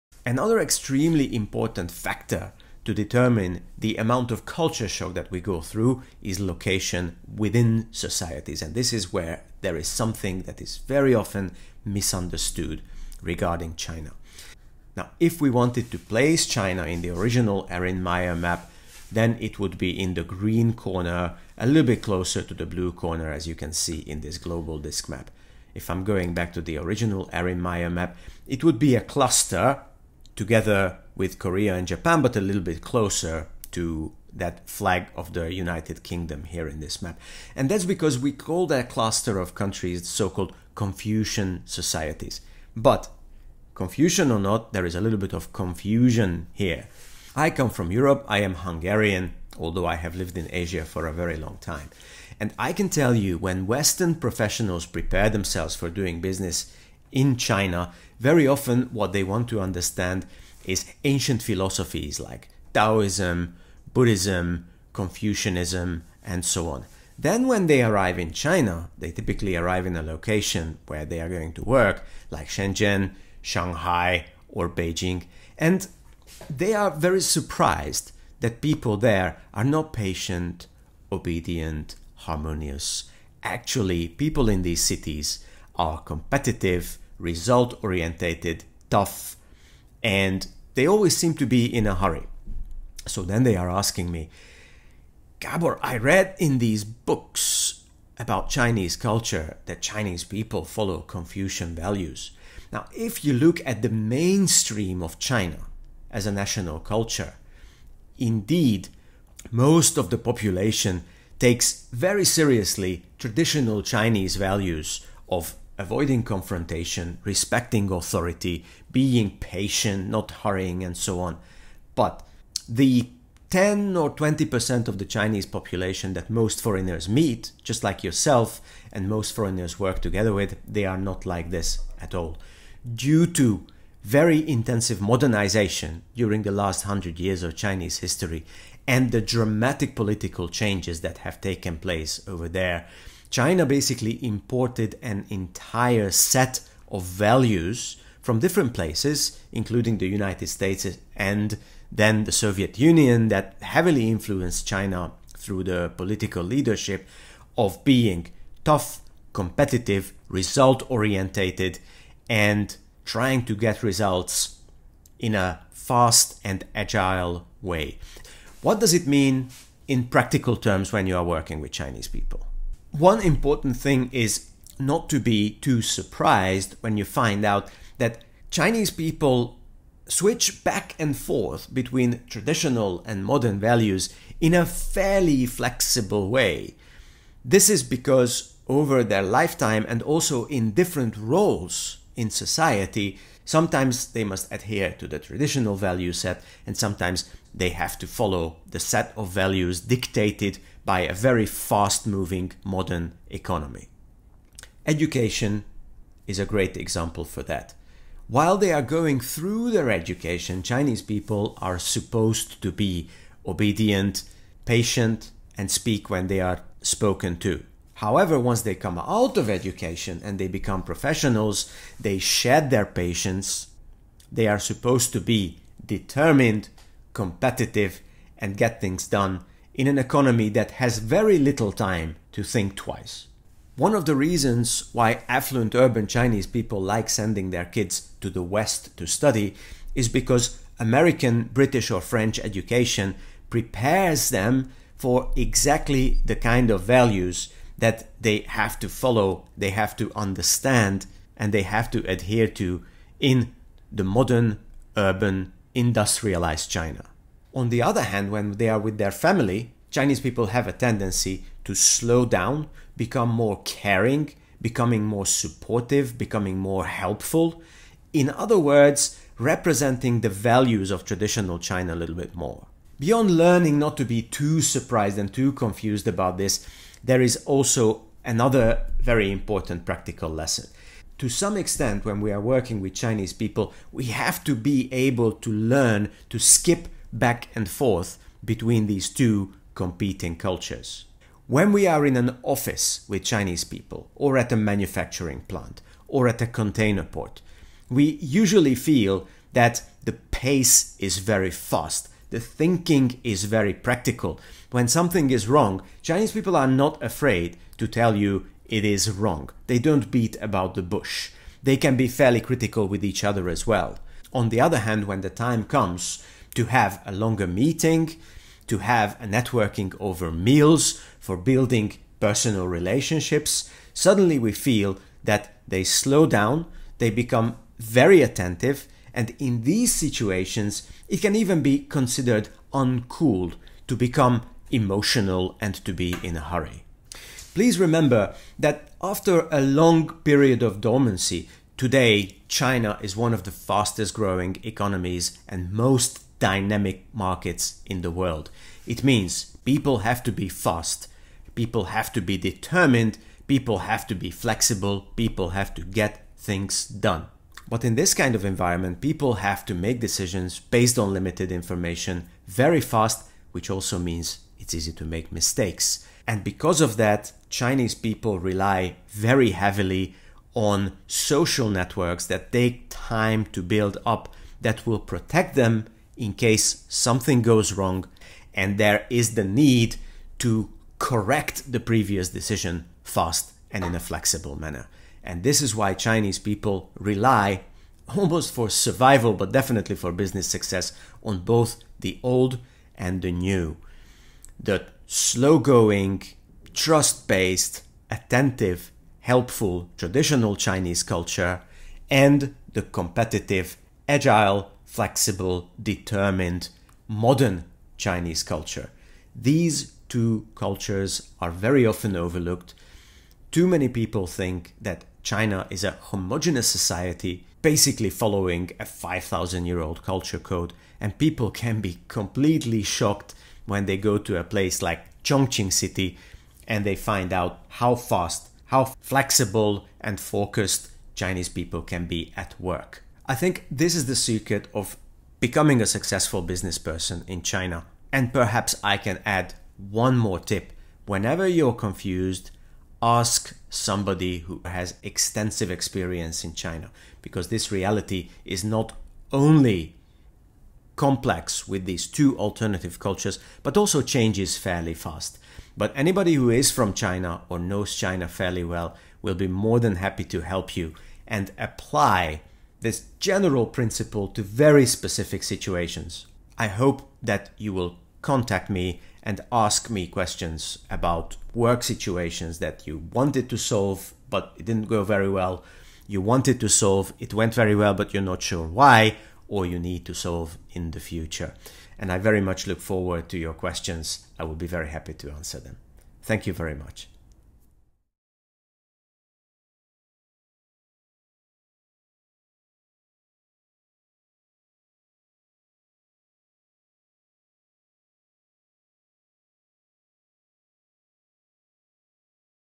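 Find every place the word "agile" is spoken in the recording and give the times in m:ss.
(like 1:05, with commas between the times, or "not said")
2:46, 6:44.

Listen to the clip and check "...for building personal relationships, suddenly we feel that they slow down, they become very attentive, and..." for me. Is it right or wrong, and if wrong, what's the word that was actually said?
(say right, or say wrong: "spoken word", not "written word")
right.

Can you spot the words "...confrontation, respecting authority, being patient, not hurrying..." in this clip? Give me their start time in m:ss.
1:56.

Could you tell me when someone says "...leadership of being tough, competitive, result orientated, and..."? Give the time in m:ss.
2:36.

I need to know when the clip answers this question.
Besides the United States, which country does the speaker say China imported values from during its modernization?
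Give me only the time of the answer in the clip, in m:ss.
2:32.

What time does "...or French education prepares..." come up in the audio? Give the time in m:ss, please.
4:01.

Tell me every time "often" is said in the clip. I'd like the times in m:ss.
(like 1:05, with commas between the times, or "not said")
0:11, 0:58, 6:51.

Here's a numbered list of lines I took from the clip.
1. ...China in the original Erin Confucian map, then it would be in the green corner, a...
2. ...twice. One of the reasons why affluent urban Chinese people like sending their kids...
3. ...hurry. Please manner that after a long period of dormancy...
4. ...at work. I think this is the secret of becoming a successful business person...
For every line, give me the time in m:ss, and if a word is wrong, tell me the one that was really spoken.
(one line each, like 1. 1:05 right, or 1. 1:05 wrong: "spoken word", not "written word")
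1. 0:16 wrong: "Meyer", not "Confucian"
2. 3:52 right
3. 5:36 wrong: "remember", not "manner"
4. 7:12 right.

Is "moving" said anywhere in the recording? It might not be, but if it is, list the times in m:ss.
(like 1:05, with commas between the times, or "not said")
3:22.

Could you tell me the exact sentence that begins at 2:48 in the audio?
What does it mean in practical terms when you are working with Chinese people?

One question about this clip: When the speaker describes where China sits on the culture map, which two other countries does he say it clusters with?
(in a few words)
Korea and Japan.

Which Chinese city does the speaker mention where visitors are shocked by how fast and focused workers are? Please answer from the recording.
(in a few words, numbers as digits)
Chongqing.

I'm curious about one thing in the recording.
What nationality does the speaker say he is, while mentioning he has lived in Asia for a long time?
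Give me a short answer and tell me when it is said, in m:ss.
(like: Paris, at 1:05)
Hungarian, at 0:48.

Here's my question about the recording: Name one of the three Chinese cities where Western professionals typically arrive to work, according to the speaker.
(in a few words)
Shenzhen.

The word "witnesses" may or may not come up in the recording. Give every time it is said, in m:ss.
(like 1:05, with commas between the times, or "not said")
not said.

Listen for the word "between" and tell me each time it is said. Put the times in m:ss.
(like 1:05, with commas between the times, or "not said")
3:01, 4:48.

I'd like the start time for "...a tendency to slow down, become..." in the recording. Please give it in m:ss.
4:20.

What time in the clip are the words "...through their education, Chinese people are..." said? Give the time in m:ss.
3:29.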